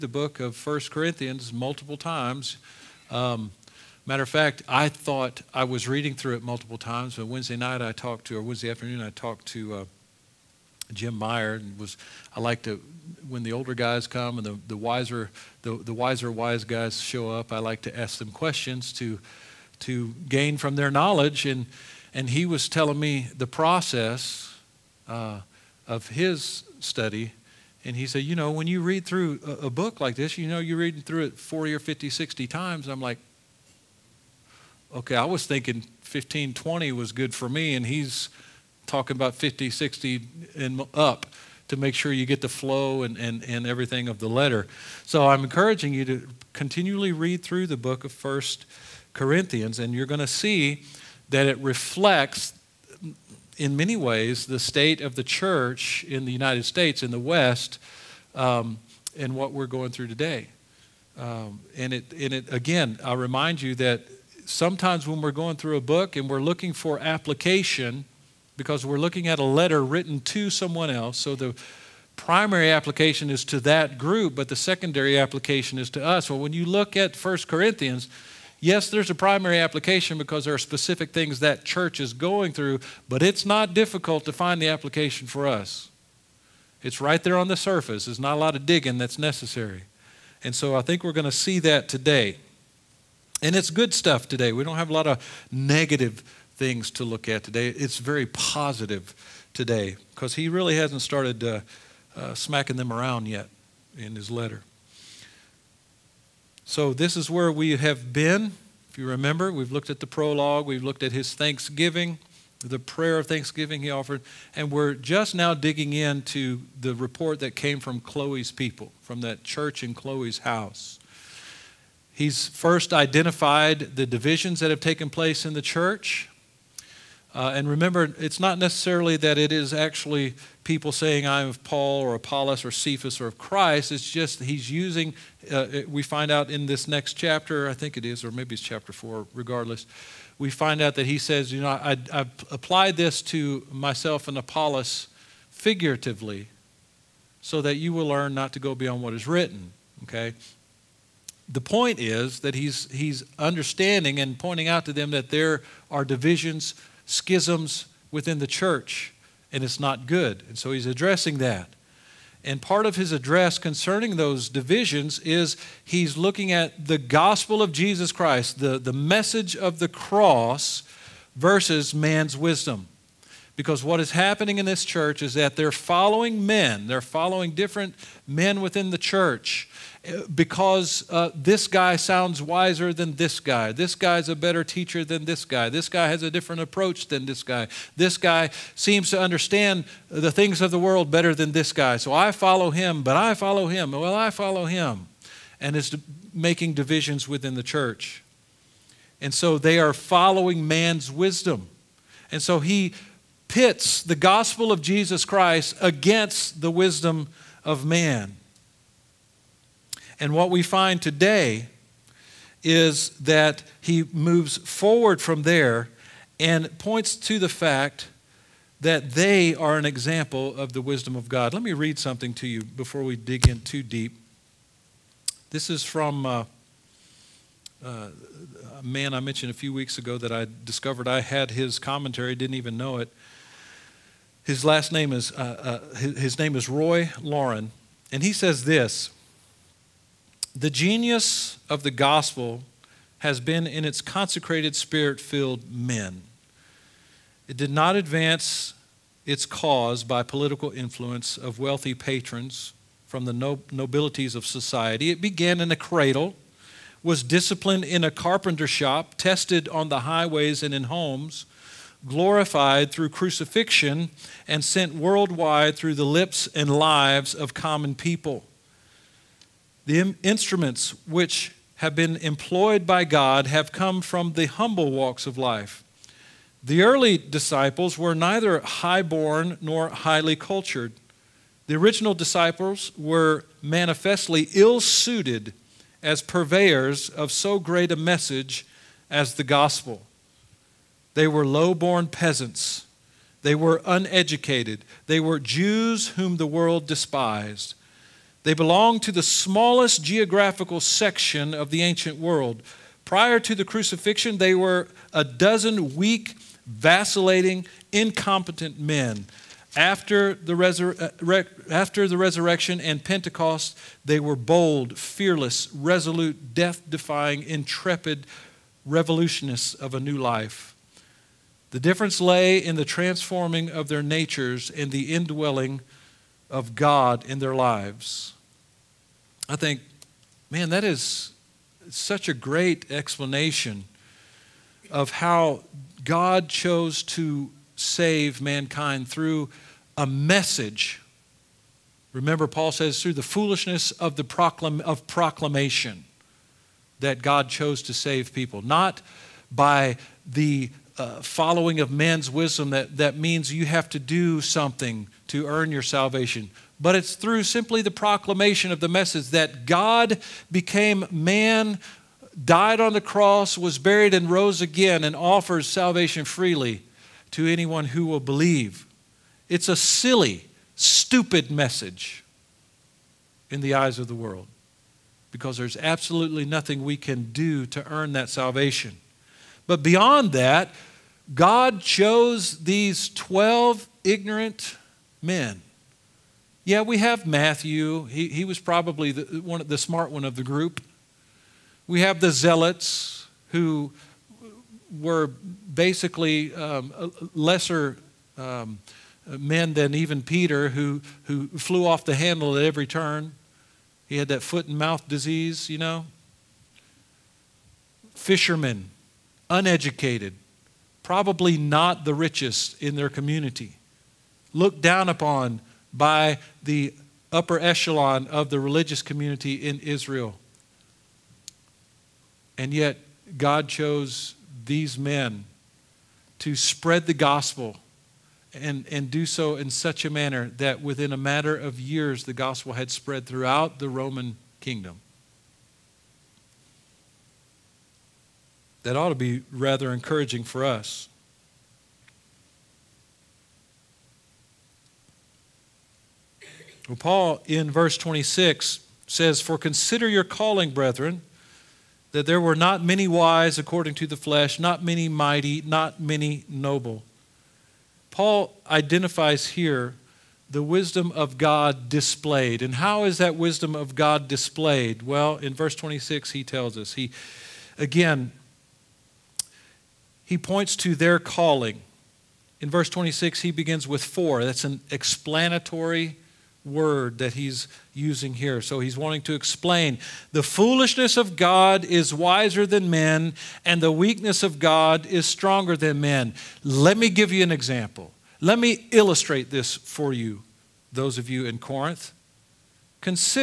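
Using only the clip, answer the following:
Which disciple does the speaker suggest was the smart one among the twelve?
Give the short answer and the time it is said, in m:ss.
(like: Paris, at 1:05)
Matthew, at 6:27.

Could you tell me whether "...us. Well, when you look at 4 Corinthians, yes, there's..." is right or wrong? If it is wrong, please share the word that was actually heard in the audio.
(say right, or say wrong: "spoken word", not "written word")
wrong: "1", not "4".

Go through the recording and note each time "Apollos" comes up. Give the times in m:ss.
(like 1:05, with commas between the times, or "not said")
2:12, 2:24.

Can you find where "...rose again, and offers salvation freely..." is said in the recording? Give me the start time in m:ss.
6:04.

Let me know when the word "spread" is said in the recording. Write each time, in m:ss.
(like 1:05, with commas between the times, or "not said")
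7:06, 7:12.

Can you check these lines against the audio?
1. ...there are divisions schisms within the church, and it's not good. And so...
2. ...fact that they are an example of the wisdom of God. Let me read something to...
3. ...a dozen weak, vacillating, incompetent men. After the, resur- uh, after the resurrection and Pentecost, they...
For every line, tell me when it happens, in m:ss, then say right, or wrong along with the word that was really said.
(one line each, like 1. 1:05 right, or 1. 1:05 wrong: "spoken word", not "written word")
1. 2:35 right
2. 3:37 right
3. 5:05 right.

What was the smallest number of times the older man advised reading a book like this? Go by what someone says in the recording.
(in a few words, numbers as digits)
40.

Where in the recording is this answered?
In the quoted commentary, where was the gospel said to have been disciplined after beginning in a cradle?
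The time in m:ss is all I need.
4:18.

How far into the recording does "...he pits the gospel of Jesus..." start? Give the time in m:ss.
3:22.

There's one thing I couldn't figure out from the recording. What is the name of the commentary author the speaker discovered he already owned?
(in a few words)
Roy Laurin.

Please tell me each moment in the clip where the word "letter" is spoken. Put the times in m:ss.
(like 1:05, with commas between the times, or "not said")
0:44, 1:09, 1:44.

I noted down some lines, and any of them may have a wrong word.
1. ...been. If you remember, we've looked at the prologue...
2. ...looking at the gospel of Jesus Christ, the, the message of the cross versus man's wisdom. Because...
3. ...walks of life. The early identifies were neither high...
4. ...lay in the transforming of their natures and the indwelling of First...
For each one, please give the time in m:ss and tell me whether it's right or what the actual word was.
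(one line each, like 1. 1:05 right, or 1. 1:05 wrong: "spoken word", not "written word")
1. 1:48 right
2. 2:46 right
3. 4:34 wrong: "disciples", not "identifies"
4. 5:22 wrong: "God", not "First".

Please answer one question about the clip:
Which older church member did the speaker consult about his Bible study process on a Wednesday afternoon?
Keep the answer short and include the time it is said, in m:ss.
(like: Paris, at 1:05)
Jim Meyer, at 0:10.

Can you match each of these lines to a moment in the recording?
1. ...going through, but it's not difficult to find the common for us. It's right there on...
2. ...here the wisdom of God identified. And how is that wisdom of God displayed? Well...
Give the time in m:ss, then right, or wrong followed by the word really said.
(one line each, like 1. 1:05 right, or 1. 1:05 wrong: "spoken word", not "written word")
1. 1:22 wrong: "application", not "common"
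2. 7:39 wrong: "displayed", not "identified".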